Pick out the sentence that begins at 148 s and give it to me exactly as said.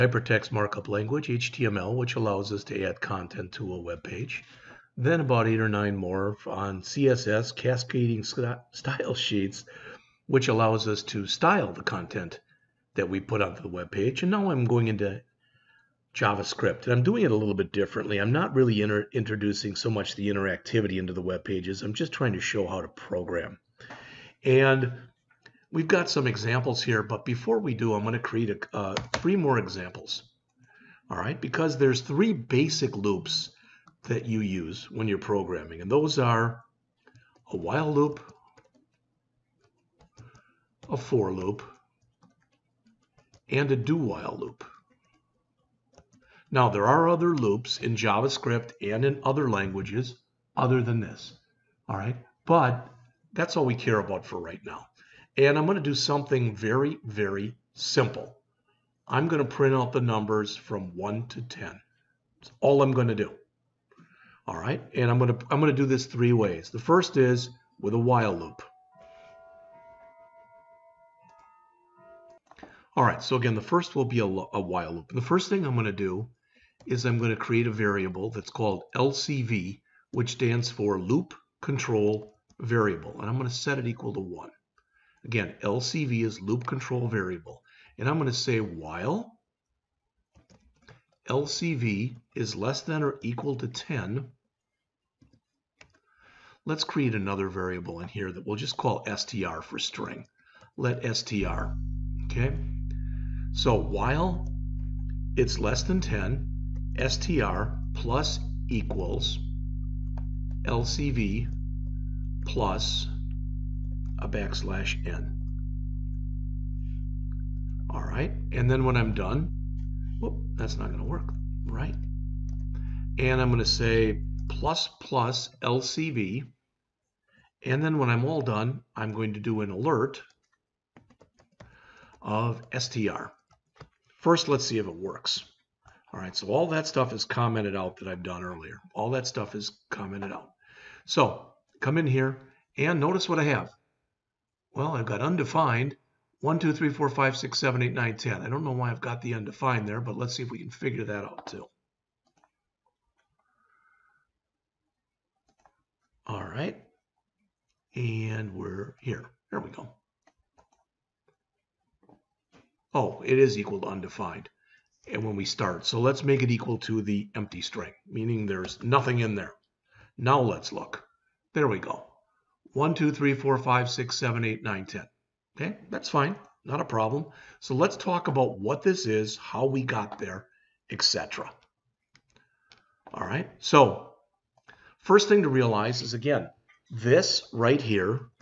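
I don't know why I've got the undefined there, but let's see if we can figure that out too.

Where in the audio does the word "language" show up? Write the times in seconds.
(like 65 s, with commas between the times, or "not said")
0 s, 49 s.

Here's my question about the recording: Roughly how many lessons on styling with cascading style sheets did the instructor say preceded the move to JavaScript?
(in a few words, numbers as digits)
8 or 9.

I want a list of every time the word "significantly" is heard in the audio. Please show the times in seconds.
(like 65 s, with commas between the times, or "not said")
not said.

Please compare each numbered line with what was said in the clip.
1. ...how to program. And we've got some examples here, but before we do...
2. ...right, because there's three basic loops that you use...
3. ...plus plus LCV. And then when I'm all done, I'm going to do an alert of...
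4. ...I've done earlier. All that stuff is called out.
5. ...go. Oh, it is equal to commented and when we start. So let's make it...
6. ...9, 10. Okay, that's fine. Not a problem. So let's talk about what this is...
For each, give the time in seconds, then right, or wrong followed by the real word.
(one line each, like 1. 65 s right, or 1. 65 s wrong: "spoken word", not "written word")
1. 22 s right
2. 31 s right
3. 124 s right
4. 138 s wrong: "commented", not "called"
5. 159 s wrong: "undefined", not "commented"
6. 174 s right.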